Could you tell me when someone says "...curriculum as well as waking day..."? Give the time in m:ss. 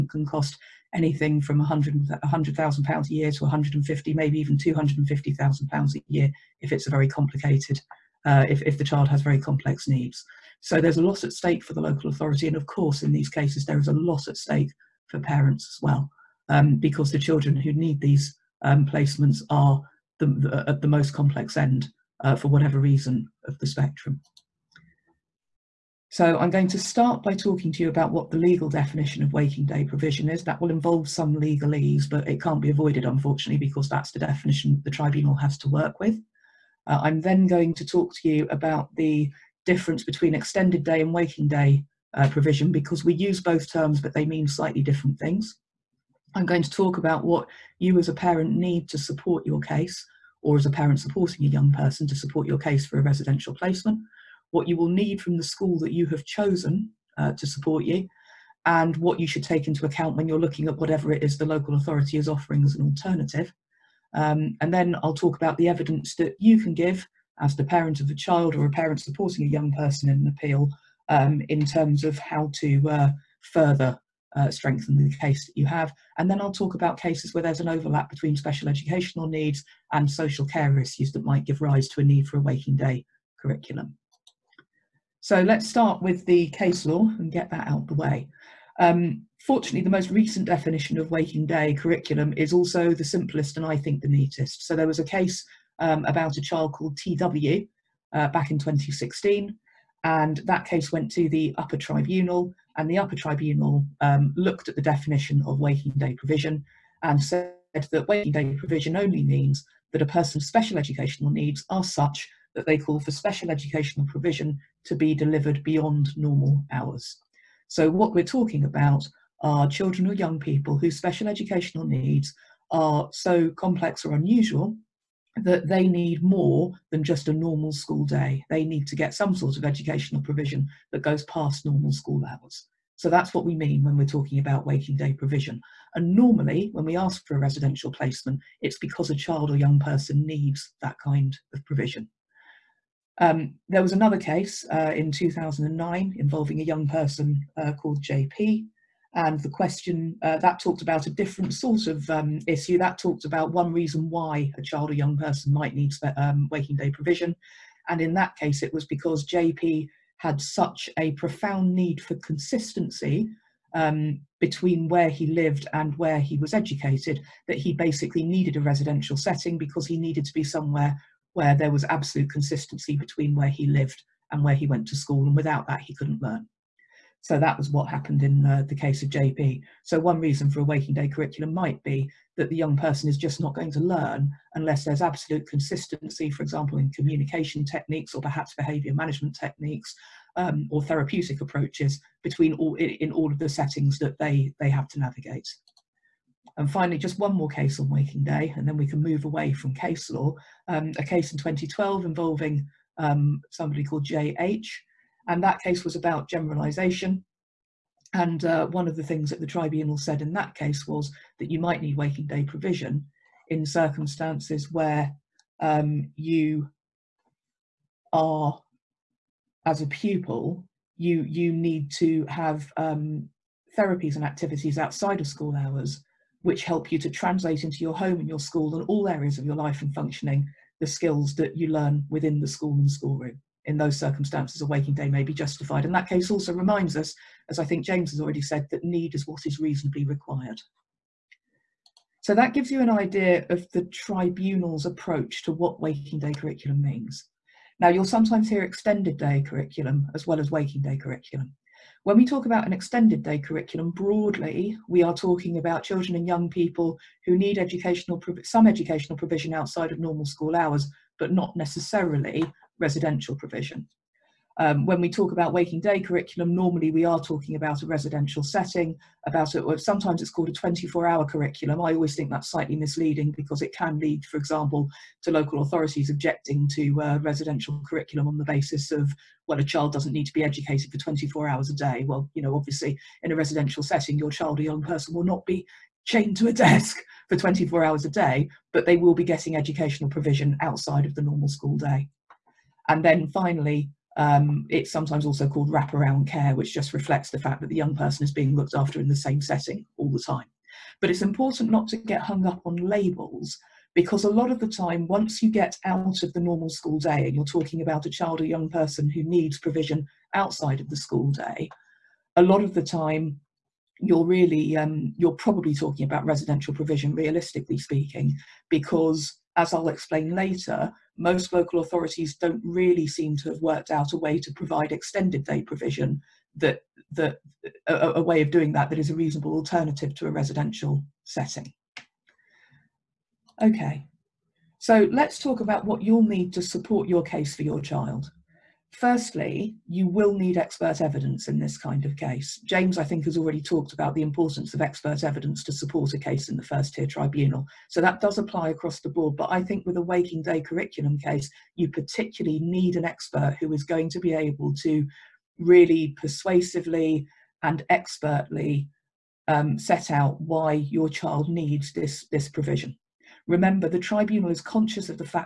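4:09.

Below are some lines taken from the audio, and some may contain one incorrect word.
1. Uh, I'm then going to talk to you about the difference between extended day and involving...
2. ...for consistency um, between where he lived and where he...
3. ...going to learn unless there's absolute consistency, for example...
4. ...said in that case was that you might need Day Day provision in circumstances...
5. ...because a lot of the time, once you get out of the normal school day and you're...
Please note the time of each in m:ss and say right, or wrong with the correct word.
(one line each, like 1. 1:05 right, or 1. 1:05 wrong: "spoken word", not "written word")
1. 0:36 wrong: "waking", not "involving"
2. 2:41 right
3. 3:03 right
4. 3:29 wrong: "Waking", not "Day"
5. 5:03 right.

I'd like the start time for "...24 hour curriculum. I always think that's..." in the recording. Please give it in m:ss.
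4:30.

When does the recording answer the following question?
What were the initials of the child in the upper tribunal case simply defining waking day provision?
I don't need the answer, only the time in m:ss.
1:36.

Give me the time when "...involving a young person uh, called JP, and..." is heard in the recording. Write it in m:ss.
2:26.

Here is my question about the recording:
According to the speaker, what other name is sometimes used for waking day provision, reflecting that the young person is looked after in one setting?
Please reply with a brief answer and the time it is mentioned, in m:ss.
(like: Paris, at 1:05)
wraparound care, at 4:55.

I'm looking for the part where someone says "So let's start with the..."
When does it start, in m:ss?
1:25.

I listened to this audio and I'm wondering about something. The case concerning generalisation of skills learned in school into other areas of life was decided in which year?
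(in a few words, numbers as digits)
2012.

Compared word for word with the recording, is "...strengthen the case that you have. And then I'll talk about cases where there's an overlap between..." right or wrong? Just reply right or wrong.
right.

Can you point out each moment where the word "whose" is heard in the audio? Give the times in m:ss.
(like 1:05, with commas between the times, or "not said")
2:00.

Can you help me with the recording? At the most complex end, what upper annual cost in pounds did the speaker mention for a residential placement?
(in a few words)
250,000 pounds.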